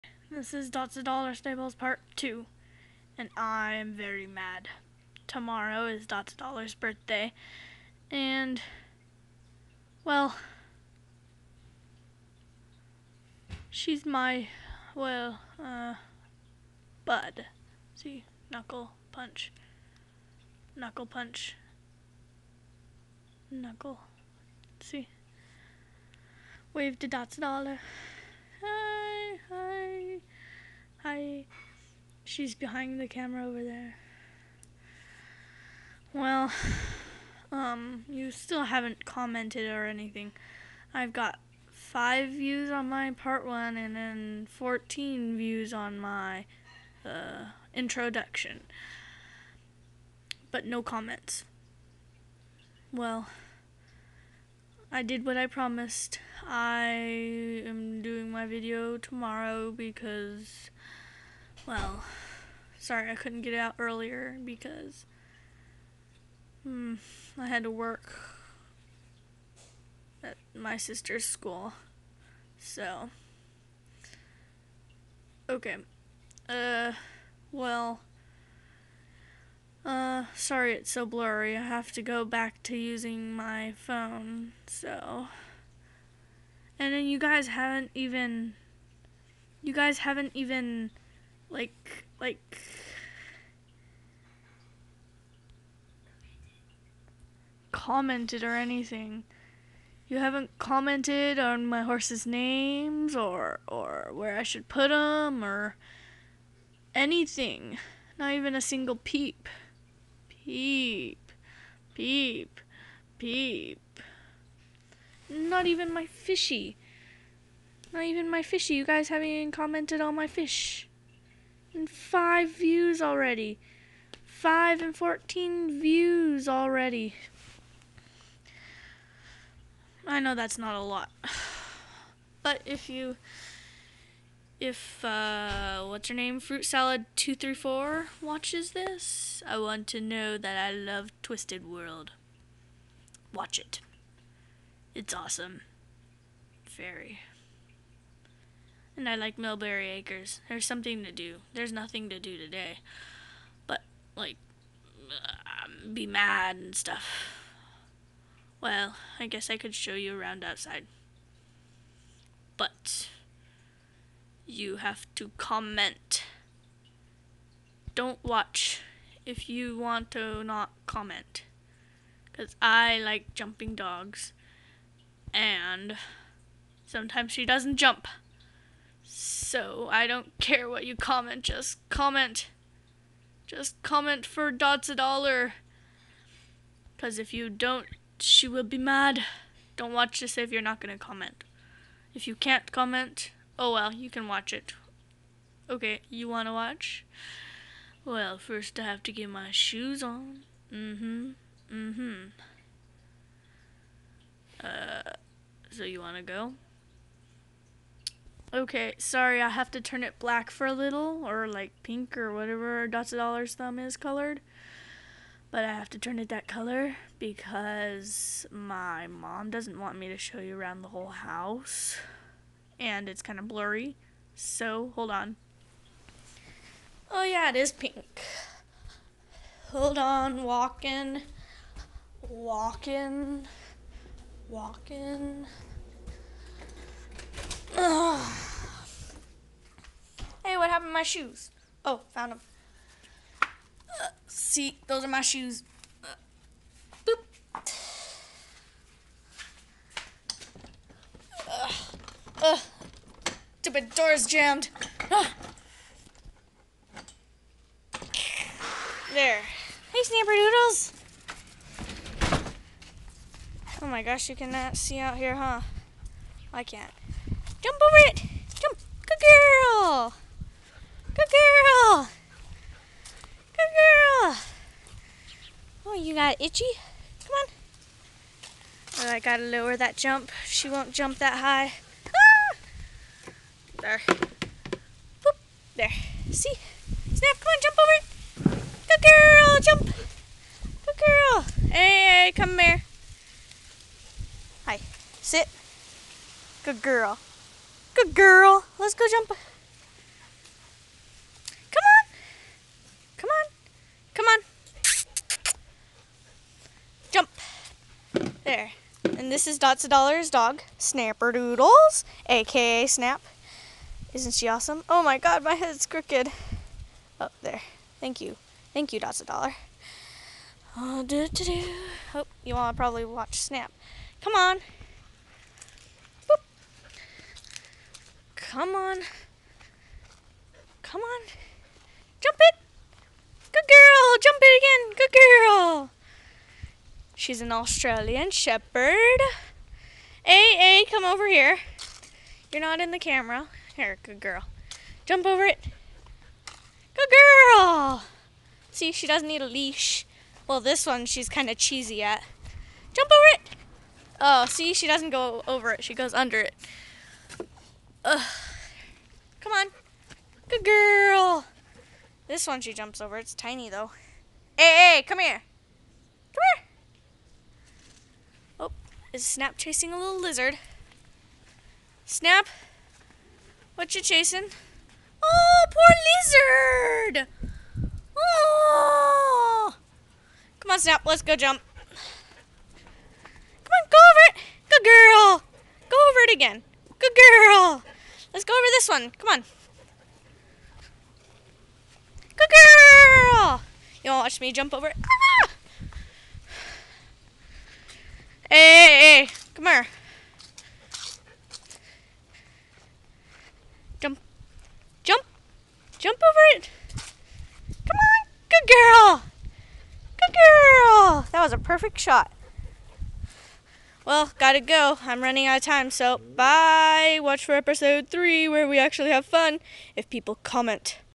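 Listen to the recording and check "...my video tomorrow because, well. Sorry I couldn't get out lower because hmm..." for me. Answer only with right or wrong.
wrong.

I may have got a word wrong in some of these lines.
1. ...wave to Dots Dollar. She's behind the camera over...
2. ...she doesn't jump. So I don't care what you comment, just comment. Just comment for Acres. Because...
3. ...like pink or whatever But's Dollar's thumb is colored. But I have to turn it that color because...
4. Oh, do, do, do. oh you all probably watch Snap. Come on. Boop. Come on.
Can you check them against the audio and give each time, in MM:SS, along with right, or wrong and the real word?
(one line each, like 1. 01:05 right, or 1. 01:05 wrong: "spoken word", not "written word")
1. 00:26 right
2. 02:57 wrong: "DotzaDollar", not "Acres"
3. 03:31 wrong: "Dot", not "But"
4. 05:20 right.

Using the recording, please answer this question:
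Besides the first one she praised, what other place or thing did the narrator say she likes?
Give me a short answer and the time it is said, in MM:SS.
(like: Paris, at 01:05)
Millberry Acres, at 02:29.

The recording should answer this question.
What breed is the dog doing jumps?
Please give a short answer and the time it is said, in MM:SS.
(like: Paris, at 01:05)
Australian Shepherd, at 05:37.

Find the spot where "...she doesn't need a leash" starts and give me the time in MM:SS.
05:48.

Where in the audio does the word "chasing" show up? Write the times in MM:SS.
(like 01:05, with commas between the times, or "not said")
06:09, 06:14.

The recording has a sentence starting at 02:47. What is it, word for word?
Don't watch if you want to not comment.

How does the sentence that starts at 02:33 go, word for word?
But, like, um, be mad and stuff.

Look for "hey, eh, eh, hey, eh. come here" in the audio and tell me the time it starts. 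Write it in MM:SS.
06:38.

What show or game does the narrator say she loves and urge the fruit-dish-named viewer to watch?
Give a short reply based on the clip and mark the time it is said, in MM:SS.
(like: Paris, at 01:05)
Twisted World, at 02:21.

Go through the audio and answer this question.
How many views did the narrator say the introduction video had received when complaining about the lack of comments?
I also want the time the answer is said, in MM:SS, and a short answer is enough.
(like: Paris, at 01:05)
14, at 00:44.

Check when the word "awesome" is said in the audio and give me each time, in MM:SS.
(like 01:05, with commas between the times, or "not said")
02:25, 05:14.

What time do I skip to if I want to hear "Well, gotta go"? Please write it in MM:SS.
06:54.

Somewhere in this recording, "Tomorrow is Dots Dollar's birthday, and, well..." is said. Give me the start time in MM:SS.
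00:05.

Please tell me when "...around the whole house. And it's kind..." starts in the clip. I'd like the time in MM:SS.
03:40.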